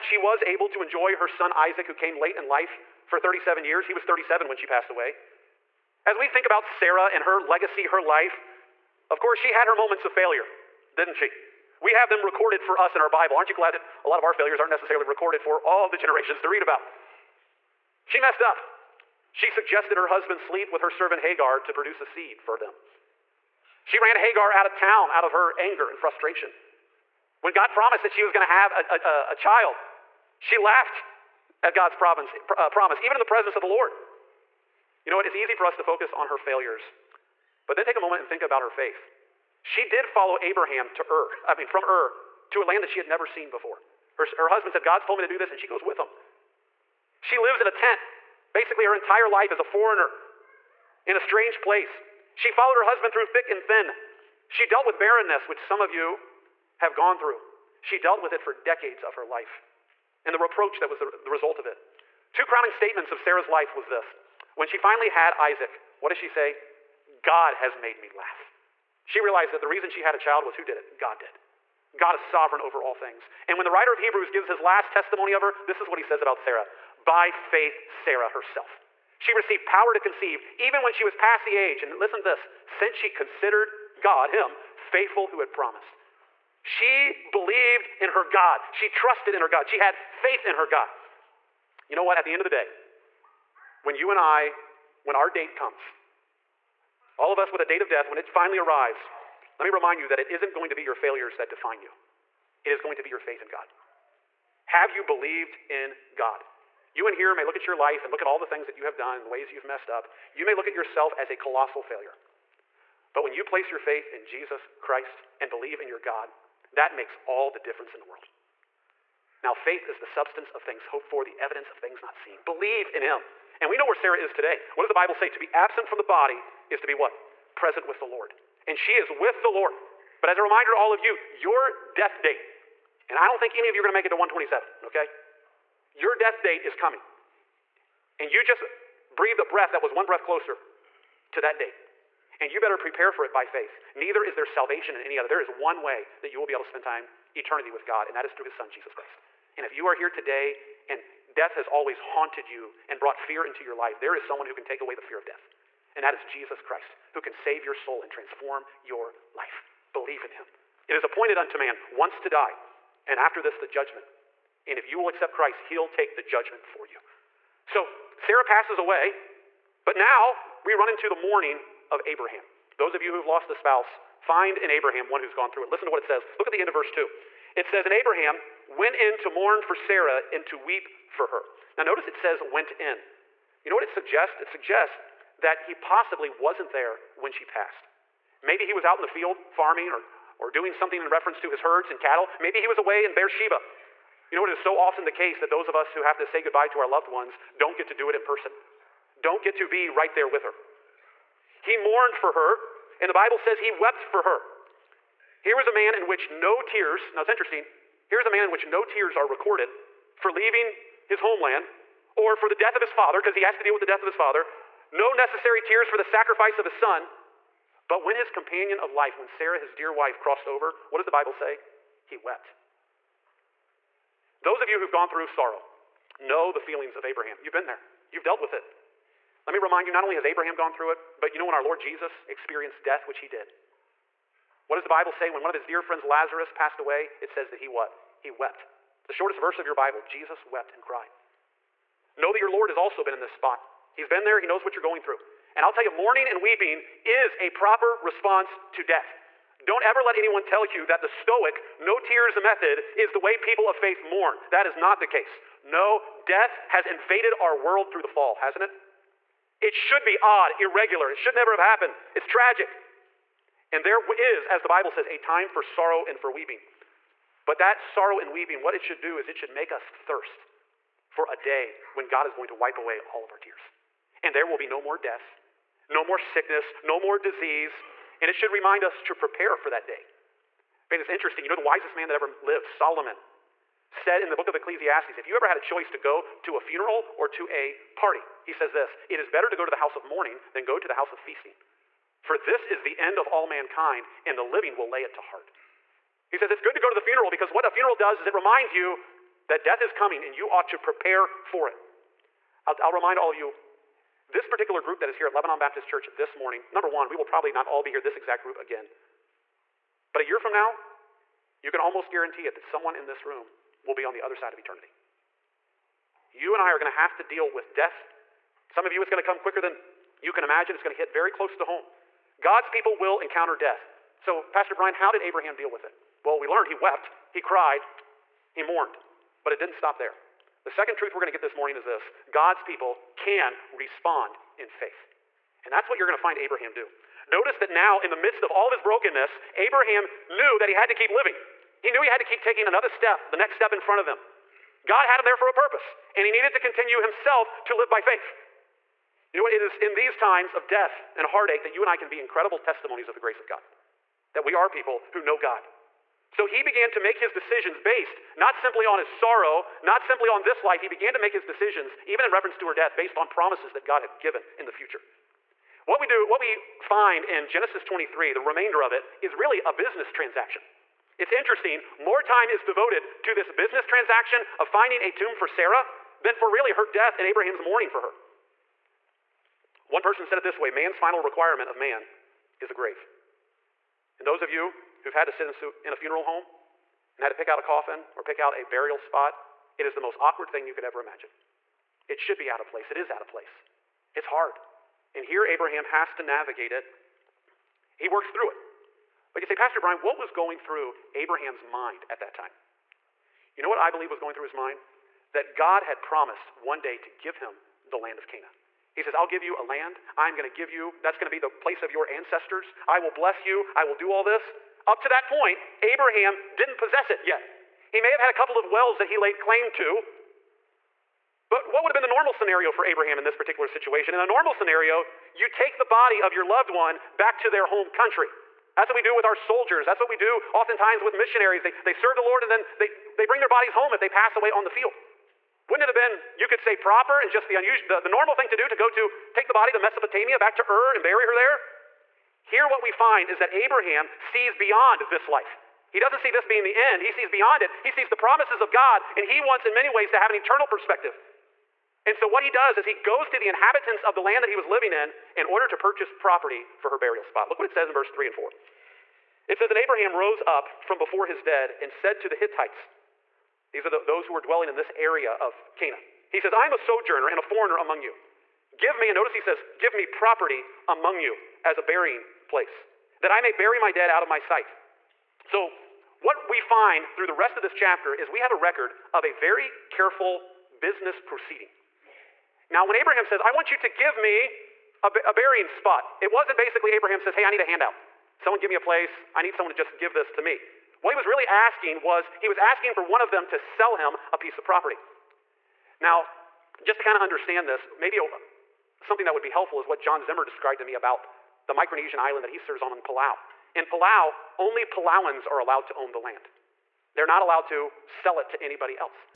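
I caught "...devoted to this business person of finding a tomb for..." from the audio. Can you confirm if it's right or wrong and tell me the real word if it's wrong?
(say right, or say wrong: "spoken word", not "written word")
wrong: "transaction", not "person".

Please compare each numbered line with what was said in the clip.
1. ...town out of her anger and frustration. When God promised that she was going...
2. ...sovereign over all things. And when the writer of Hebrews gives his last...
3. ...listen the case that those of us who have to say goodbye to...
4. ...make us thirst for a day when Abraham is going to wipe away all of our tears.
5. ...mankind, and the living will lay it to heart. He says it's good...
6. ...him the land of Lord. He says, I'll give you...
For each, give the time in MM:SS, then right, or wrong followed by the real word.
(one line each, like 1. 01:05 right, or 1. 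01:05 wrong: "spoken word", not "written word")
1. 00:24 right
2. 01:12 right
3. 03:14 wrong: "often", not "listen"
4. 04:29 wrong: "God", not "Abraham"
5. 04:53 right
6. 06:47 wrong: "Canaan", not "Lord".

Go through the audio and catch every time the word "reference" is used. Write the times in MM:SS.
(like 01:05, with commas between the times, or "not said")
03:11, 06:02.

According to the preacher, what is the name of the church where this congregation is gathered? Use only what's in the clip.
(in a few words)
Lebanon Baptist Church.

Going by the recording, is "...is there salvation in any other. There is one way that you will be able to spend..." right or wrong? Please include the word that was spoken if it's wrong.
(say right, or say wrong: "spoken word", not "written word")
right.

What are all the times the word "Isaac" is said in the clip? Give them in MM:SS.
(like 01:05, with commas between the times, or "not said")
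00:01, 01:05.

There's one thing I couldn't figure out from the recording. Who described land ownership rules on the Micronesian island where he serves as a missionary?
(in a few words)
John Zimmer.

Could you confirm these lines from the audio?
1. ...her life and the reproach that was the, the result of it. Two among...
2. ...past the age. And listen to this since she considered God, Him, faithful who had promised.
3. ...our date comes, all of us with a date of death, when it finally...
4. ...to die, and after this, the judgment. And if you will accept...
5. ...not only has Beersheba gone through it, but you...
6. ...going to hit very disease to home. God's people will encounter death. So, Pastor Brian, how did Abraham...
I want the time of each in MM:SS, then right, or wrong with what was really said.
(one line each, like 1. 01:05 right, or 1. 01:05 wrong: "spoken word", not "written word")
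1. 00:59 wrong: "crowning", not "among"
2. 01:21 right
3. 01:35 right
4. 02:42 right
5. 03:49 wrong: "Abraham", not "Beersheba"
6. 05:20 wrong: "close", not "disease".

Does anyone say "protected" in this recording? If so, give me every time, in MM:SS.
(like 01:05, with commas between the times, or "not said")
not said.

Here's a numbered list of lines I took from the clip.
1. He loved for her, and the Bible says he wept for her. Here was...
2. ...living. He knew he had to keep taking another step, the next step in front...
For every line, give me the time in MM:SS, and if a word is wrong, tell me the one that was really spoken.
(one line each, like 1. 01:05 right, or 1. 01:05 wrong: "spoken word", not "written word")
1. 03:21 wrong: "mourned", not "loved"
2. 05:41 right.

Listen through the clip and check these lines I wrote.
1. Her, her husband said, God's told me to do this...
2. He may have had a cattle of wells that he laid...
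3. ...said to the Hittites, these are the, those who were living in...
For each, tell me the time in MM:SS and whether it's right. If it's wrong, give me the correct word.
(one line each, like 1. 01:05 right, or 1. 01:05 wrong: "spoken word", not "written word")
1. 00:44 right
2. 06:57 wrong: "couple", not "cattle"
3. 07:41 wrong: "dwelling", not "living".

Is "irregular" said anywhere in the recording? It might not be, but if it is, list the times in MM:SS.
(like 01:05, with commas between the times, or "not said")
04:20.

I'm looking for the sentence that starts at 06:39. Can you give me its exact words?
But you say, Pastor Brian, what was going through Abraham's mind at that time?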